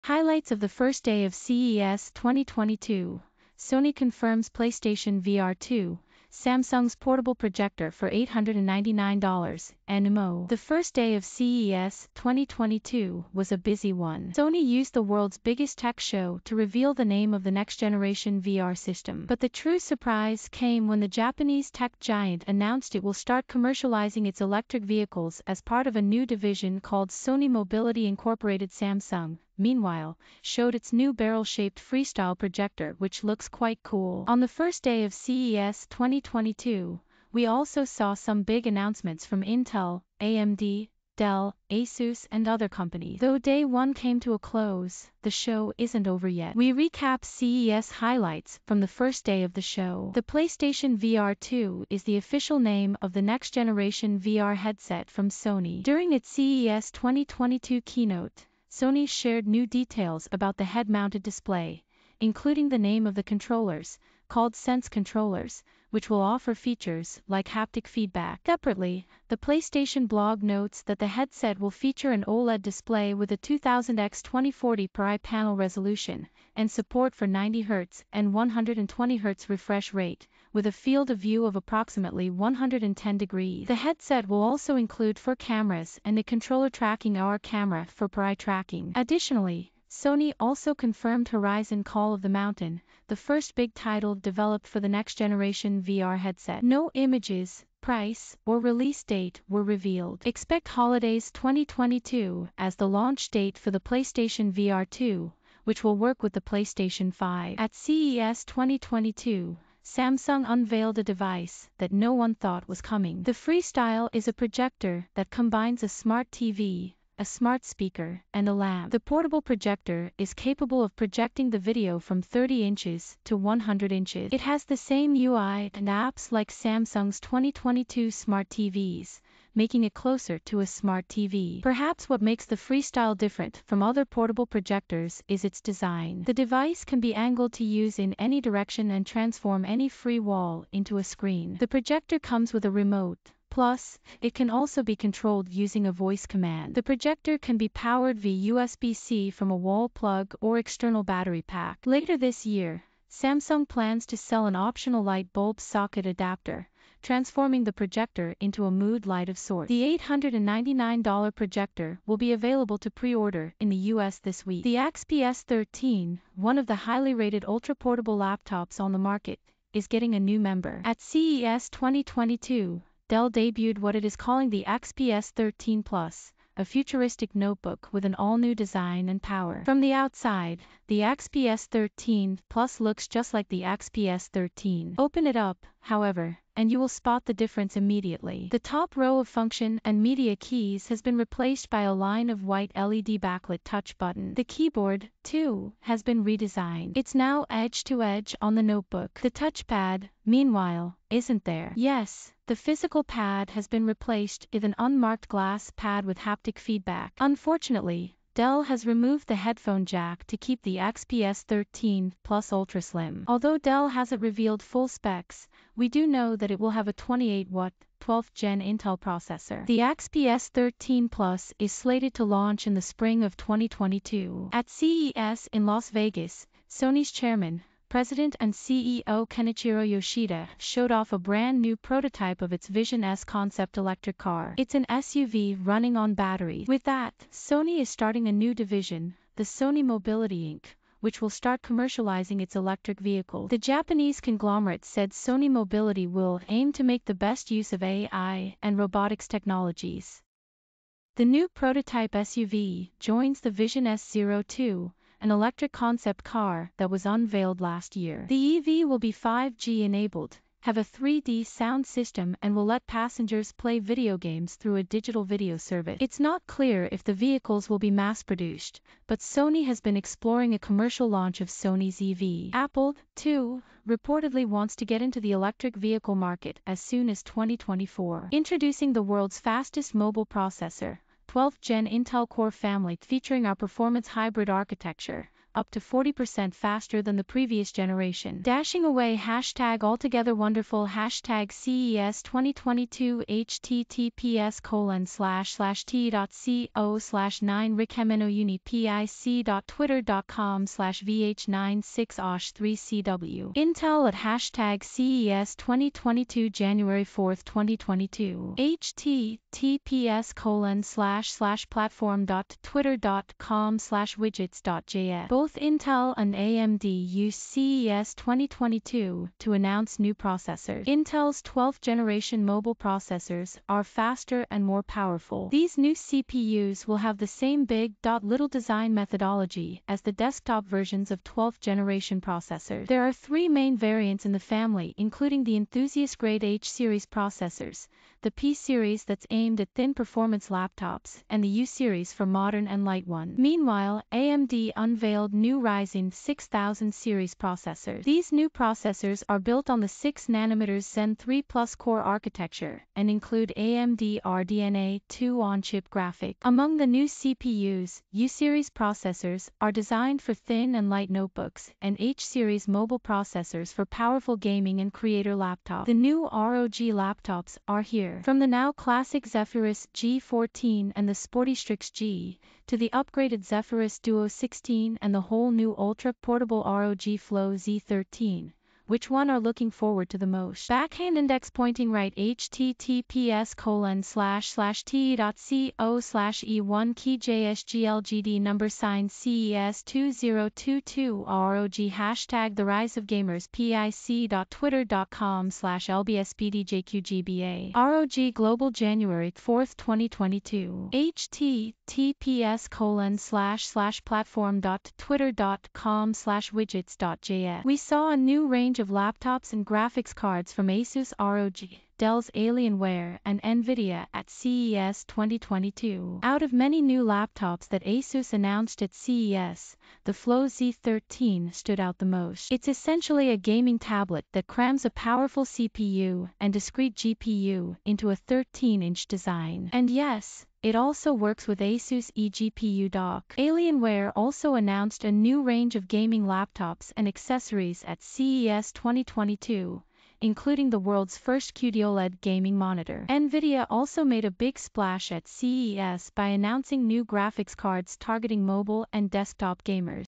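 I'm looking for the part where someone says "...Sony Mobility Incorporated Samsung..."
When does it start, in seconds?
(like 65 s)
27 s.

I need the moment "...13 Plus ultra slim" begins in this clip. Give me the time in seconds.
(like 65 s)
211 s.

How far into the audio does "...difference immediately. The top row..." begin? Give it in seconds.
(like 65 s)
187 s.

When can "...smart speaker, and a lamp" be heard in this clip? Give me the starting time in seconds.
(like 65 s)
117 s.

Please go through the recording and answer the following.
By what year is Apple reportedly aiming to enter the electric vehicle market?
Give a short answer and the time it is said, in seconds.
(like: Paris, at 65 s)
2024, at 277 s.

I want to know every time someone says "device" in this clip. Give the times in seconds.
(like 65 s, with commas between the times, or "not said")
111 s, 136 s.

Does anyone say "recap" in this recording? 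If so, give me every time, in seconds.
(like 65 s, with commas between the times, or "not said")
46 s.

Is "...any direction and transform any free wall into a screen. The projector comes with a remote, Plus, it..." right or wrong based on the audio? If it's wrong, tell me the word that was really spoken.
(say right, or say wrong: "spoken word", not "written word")
right.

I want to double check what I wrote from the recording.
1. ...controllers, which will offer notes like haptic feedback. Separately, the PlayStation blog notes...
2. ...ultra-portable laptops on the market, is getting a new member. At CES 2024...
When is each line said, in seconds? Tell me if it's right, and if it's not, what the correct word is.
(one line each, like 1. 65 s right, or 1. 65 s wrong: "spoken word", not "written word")
1. 64 s wrong: "features", not "notes"
2. 167 s wrong: "2022", not "2024".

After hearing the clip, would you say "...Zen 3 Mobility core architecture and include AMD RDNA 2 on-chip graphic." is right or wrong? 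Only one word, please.
wrong.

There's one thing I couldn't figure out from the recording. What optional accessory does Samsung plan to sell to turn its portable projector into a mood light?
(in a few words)
light bulb socket adapter.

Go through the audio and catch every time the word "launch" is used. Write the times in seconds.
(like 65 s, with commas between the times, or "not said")
102 s, 222 s, 271 s.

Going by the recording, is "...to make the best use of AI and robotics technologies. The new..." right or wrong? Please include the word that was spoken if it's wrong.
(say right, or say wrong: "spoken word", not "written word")
right.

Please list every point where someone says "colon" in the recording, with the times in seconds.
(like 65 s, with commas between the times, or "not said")
294 s, 310 s, 383 s, 402 s.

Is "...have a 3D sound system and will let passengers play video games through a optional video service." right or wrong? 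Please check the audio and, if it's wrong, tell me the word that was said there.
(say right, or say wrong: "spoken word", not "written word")
wrong: "digital", not "optional".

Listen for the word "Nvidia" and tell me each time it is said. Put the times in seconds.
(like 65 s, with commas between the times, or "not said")
413 s, 443 s.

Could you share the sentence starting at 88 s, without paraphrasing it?
Additionally, Sony also confirmed Horizon Call of the Mountain, the first big title developed for the next generation VR headset.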